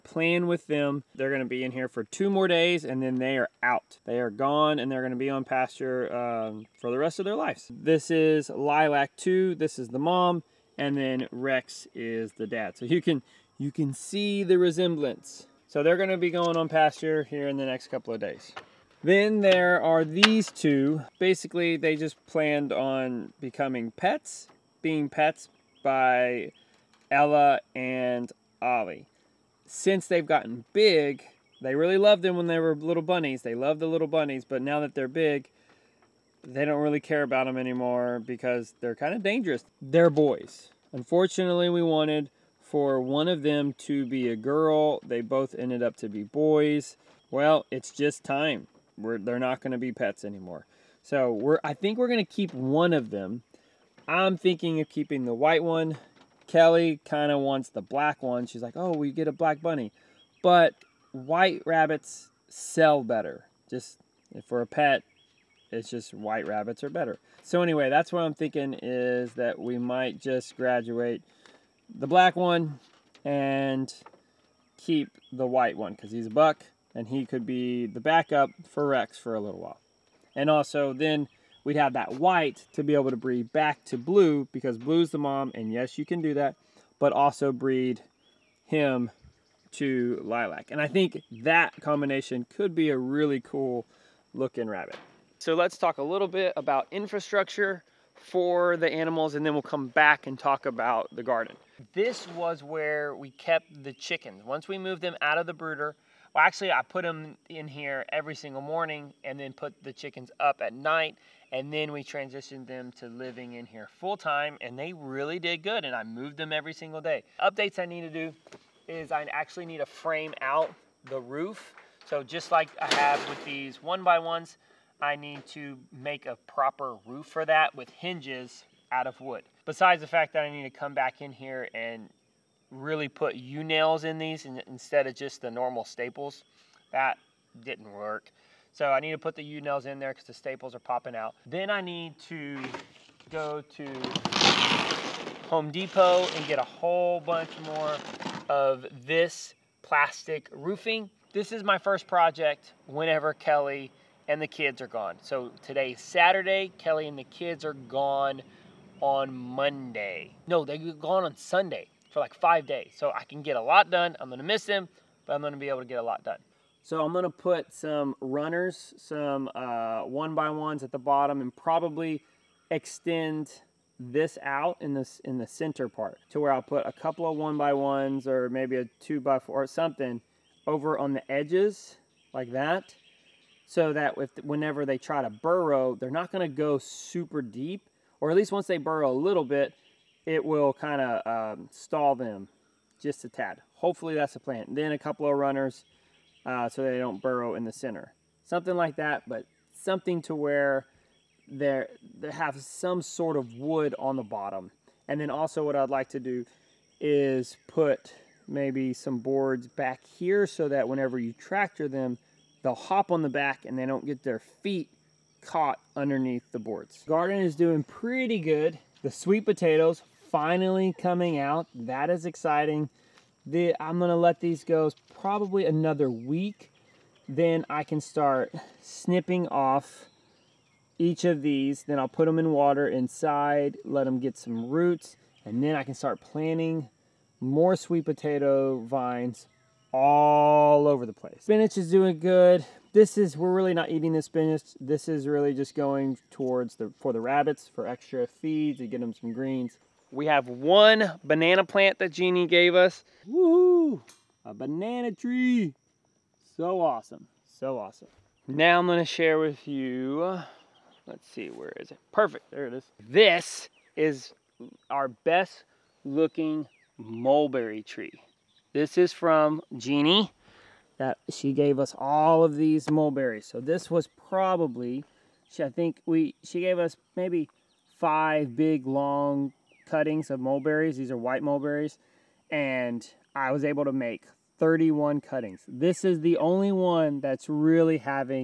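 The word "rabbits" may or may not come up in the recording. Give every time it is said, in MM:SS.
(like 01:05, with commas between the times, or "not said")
01:01, 01:06, 01:34, 04:07.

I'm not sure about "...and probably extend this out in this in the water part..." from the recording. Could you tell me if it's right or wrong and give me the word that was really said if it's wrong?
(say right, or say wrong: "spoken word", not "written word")
wrong: "center", not "water".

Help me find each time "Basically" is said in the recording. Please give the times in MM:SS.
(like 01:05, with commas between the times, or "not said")
00:21.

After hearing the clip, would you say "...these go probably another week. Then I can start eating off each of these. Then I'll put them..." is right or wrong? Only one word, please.
wrong.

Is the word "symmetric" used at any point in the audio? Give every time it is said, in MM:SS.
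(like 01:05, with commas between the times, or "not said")
not said.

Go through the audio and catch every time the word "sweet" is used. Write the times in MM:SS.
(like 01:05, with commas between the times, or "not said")
03:39, 03:57.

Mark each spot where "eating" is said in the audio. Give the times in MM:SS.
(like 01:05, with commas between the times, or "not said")
04:03.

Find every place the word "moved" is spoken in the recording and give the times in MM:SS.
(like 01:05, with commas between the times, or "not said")
01:44, 01:56.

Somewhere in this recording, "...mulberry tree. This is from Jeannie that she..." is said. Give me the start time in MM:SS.
04:26.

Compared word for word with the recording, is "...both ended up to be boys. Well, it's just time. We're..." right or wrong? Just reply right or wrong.
right.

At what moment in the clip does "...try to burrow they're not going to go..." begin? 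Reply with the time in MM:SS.
03:04.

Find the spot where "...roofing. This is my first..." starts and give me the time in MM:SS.
02:30.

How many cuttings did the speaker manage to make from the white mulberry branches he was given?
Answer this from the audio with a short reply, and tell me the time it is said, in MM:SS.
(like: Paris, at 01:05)
31, at 04:44.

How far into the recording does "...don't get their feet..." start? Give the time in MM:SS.
03:33.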